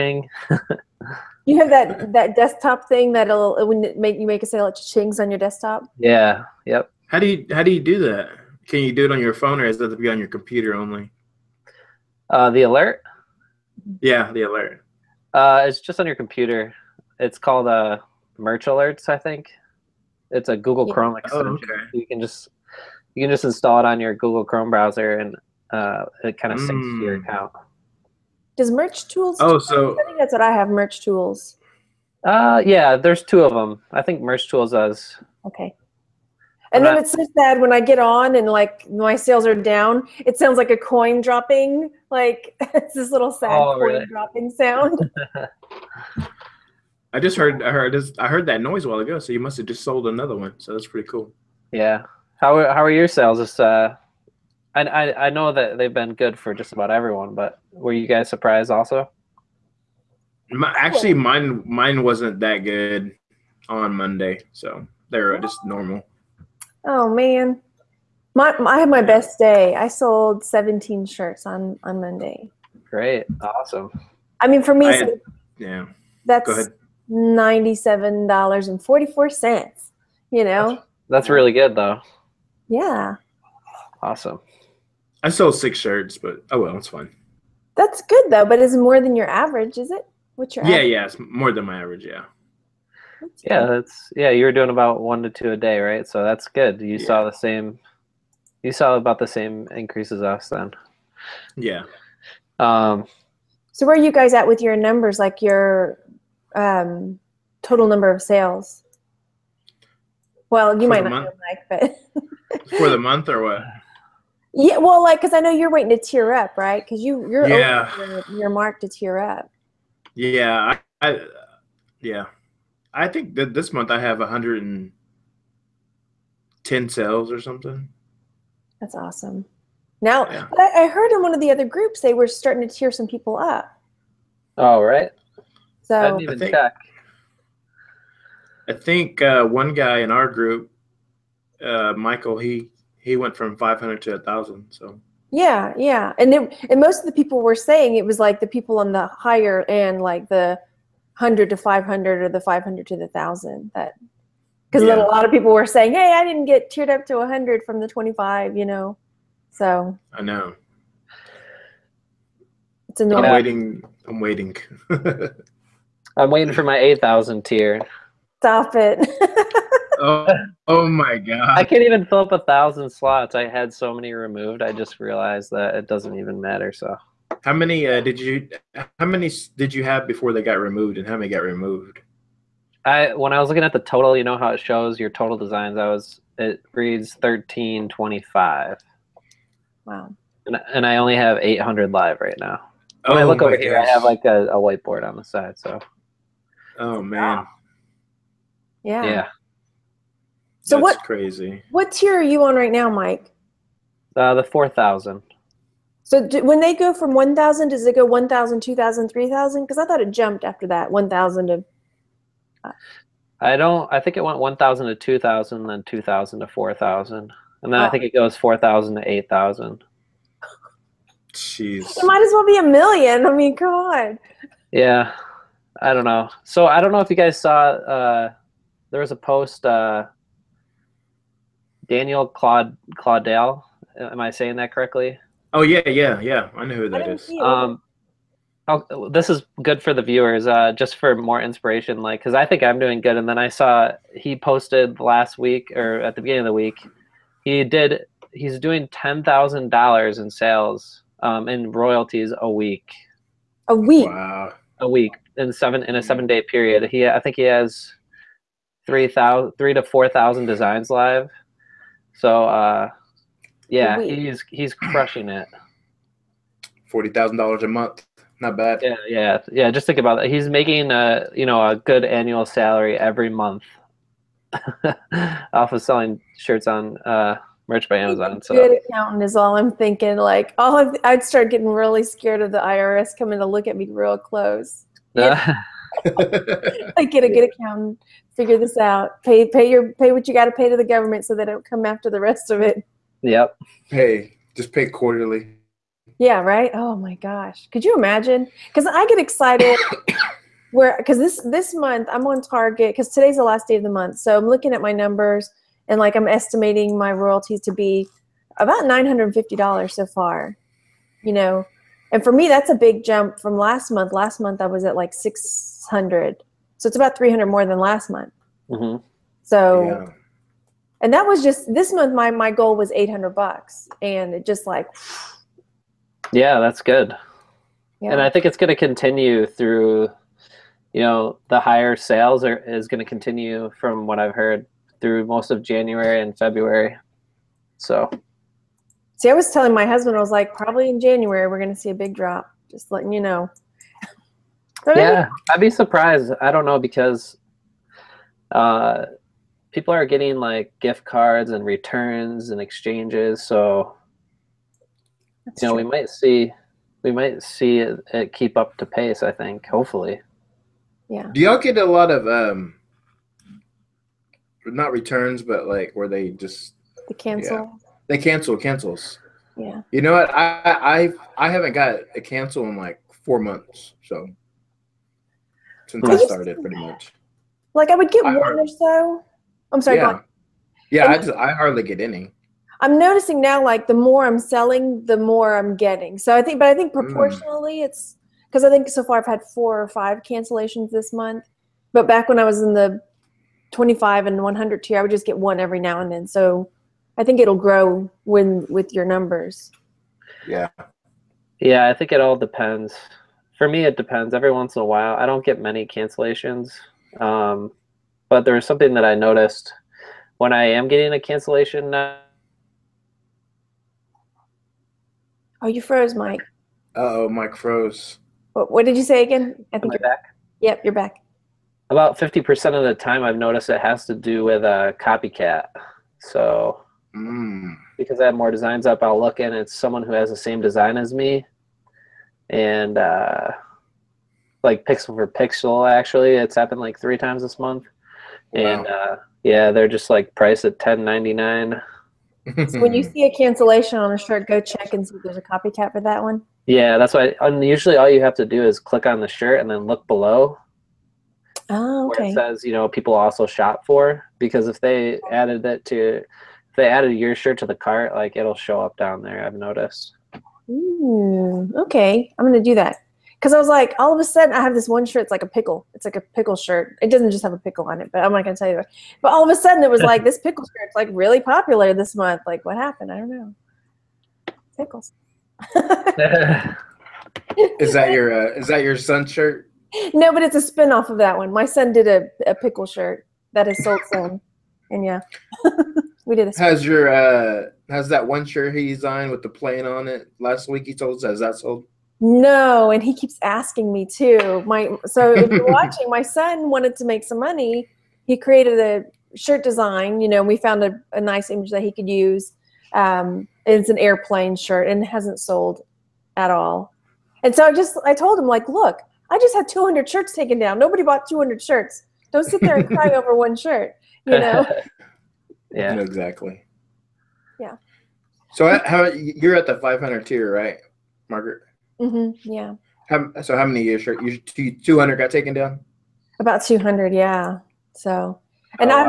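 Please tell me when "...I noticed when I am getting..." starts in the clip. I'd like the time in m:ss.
6:49.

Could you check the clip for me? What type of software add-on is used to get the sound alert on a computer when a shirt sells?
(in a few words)
Chrome extension.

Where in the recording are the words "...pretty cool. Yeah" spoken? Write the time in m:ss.
0:50.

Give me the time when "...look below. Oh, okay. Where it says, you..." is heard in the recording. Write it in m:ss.
7:29.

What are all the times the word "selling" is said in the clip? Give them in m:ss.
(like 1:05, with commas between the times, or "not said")
4:35, 6:24.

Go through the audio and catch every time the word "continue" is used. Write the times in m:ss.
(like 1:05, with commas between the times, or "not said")
5:28, 5:33.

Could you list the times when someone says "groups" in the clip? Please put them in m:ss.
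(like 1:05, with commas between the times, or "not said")
2:11, 2:20.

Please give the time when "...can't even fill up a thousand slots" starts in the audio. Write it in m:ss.
2:51.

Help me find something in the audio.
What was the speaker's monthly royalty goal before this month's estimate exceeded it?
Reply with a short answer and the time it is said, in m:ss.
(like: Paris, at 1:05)
$800, at 5:22.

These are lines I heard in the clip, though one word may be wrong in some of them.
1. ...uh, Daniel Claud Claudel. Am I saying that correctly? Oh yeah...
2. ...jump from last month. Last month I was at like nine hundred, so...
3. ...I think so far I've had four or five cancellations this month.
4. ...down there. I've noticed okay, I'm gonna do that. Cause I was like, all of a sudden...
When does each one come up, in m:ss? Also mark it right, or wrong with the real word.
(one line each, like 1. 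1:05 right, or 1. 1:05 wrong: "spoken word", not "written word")
1. 3:49 right
2. 5:13 wrong: "six", not "nine"
3. 6:28 right
4. 7:38 right.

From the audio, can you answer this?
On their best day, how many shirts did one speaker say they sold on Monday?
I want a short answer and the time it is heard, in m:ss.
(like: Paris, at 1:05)
17, at 1:10.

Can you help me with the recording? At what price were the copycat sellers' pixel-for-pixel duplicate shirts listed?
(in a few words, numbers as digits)
$10.99.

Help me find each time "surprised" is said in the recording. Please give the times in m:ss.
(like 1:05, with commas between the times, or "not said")
0:58, 5:45.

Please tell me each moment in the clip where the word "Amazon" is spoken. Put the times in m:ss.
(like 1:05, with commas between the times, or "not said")
4:37.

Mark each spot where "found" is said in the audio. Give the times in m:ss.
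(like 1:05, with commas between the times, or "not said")
8:20.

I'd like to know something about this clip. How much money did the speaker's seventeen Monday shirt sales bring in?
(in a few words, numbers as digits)
$97.44.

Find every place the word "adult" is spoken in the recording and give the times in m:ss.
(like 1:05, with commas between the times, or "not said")
not said.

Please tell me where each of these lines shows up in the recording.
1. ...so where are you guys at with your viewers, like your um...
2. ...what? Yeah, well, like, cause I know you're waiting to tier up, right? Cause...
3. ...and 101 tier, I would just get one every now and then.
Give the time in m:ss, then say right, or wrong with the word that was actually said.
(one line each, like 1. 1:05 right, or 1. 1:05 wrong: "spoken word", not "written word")
1. 1:43 wrong: "numbers", not "viewers"
2. 1:53 right
3. 6:34 wrong: "100", not "101".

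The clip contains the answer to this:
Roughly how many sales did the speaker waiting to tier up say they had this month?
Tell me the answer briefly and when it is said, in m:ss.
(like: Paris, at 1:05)
110, at 2:04.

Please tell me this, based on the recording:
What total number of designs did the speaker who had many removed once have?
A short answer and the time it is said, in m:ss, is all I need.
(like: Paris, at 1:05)
1325, at 3:07.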